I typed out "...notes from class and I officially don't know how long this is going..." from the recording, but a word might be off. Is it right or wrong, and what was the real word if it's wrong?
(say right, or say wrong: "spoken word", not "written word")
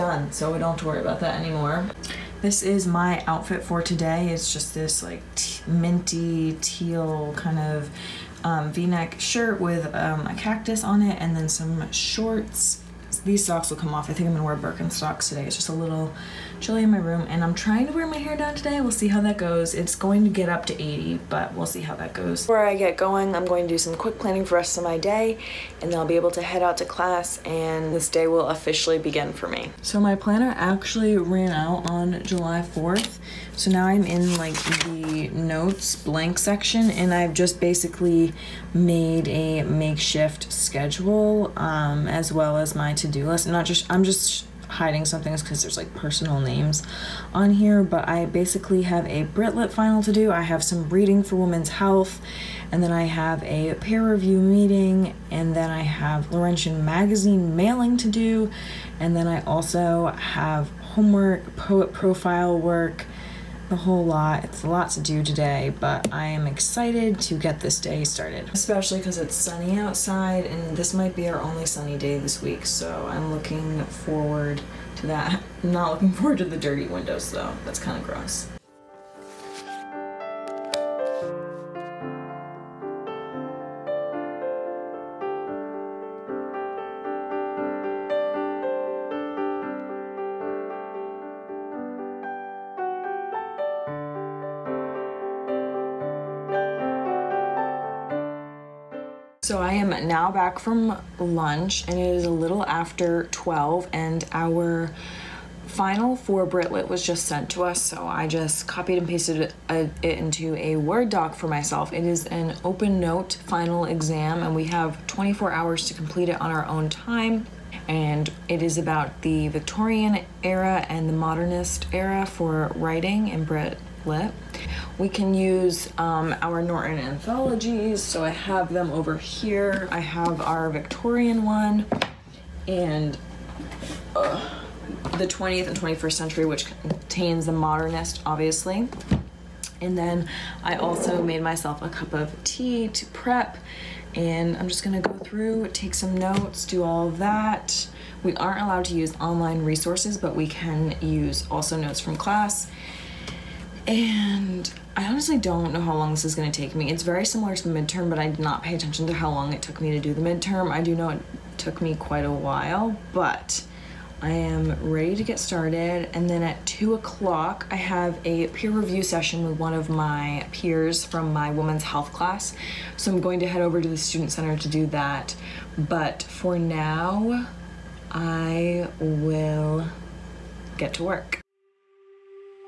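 wrong: "honestly", not "officially".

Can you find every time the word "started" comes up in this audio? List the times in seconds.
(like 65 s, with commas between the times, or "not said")
68 s, 165 s.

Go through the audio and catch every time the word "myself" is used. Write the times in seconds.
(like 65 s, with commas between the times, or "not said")
111 s, 141 s.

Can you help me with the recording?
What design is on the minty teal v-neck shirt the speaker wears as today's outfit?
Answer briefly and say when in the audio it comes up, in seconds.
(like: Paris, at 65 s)
cactus, at 10 s.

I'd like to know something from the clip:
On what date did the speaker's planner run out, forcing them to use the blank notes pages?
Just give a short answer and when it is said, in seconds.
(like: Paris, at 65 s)
July 4, at 32 s.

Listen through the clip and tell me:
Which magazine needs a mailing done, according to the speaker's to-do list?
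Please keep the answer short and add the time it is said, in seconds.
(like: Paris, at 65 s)
Laurentian magazine, at 56 s.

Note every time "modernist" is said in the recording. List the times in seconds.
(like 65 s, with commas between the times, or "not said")
121 s, 137 s.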